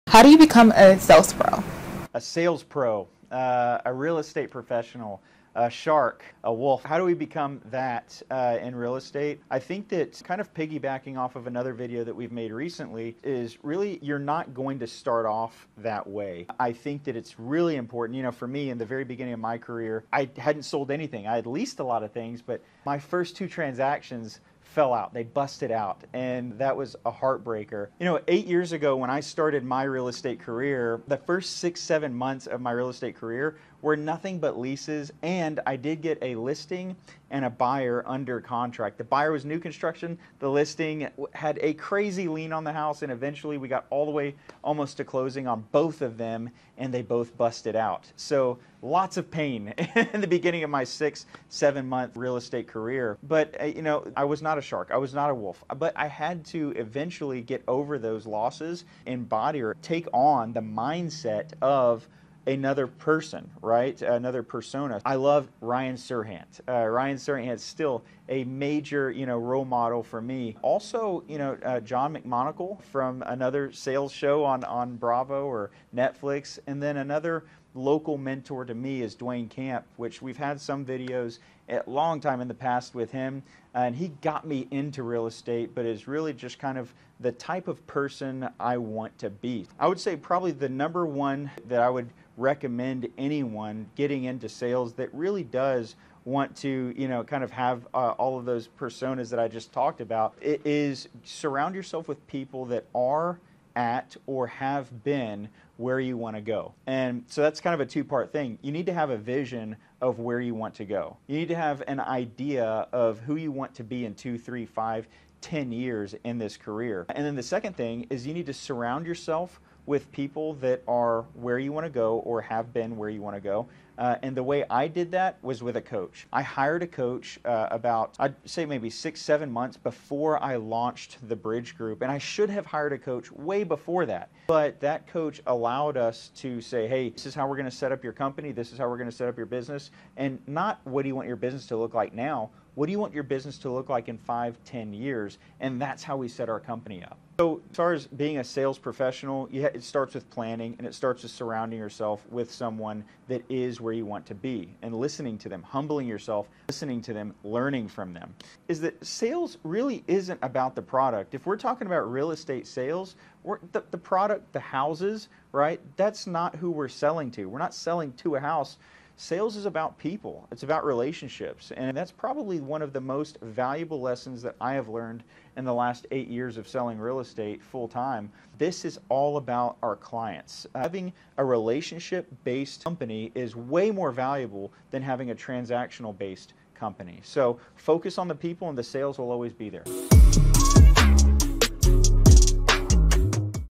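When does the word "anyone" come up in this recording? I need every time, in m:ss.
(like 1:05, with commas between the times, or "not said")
1:33.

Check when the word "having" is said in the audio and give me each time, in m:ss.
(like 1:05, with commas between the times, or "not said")
3:00, 3:05.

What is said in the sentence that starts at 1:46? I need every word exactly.
And so that's kind of a two part thing.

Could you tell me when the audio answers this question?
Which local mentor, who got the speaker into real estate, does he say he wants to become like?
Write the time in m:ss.
1:19.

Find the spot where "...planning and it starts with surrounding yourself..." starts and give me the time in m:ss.
2:30.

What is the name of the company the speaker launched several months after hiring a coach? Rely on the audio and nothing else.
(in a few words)
the Bridge Group.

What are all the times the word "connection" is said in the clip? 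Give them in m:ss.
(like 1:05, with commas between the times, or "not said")
not said.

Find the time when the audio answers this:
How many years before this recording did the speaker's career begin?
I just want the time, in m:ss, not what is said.
0:28.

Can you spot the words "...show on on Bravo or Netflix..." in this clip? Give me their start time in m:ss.
1:14.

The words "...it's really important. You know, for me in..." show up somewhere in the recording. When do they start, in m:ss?
0:17.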